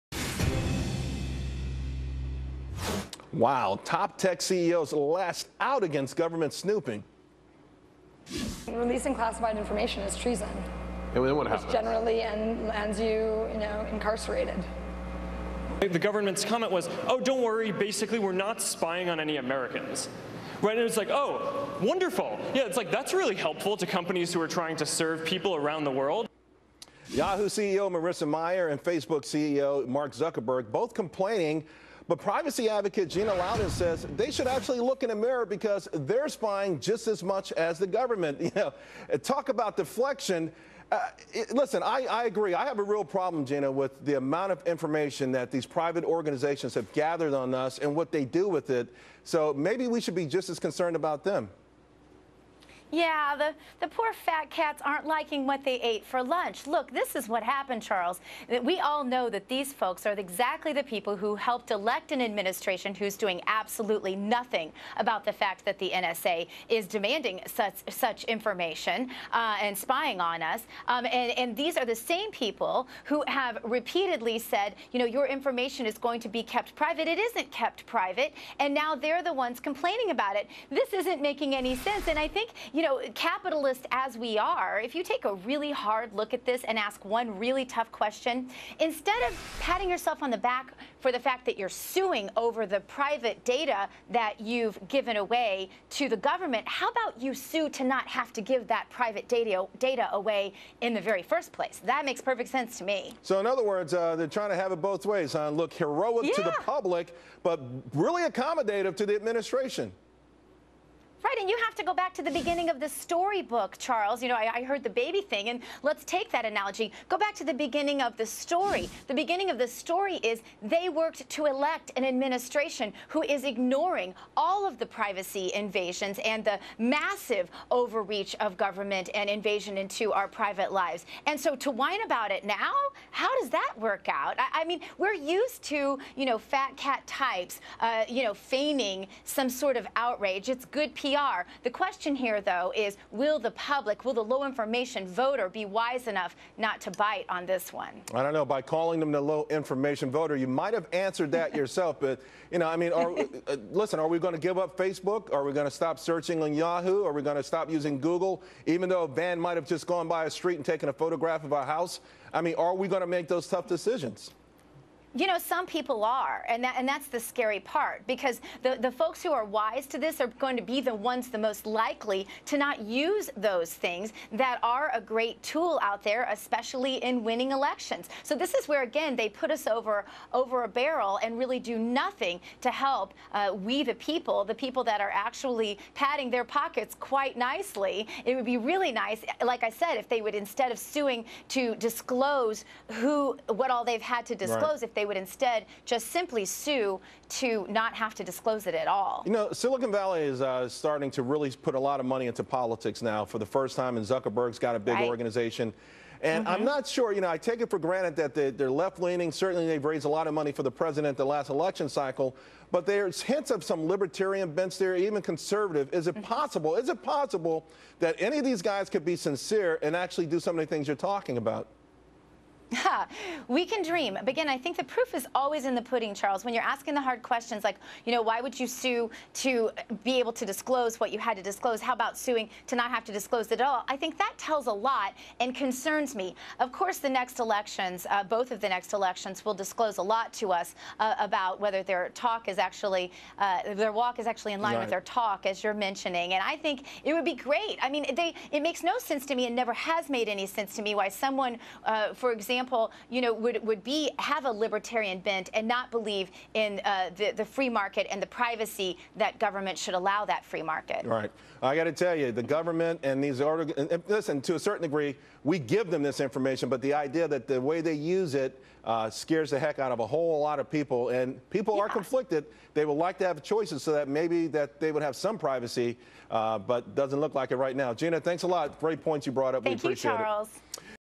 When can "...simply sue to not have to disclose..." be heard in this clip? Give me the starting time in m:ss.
3:16.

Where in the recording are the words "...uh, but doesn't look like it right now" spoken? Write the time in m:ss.
4:36.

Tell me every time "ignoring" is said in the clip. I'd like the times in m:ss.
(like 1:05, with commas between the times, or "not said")
2:03.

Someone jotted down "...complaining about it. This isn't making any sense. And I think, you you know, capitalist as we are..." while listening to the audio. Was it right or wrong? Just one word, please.
right.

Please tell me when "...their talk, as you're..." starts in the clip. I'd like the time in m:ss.
4:04.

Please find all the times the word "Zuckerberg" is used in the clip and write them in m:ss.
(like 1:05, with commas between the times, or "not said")
0:30, 3:24.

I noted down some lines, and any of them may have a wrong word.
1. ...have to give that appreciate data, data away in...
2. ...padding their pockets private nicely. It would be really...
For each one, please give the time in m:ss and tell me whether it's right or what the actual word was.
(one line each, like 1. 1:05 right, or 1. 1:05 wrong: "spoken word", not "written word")
1. 1:38 wrong: "private", not "appreciate"
2. 3:05 wrong: "quite", not "private".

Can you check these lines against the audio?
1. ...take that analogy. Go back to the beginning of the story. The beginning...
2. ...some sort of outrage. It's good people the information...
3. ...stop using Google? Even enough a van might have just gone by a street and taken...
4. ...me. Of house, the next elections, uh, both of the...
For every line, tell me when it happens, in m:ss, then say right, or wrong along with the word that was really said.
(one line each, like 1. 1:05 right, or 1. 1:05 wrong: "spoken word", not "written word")
1. 1:56 right
2. 2:19 wrong: "question", not "information"
3. 2:37 wrong: "though", not "enough"
4. 3:56 wrong: "course", not "house".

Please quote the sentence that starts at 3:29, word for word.
Certainly, they've raised a lot of money for the president the last election cycle.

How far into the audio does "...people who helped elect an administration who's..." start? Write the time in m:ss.
1:00.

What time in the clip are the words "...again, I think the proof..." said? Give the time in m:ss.
3:44.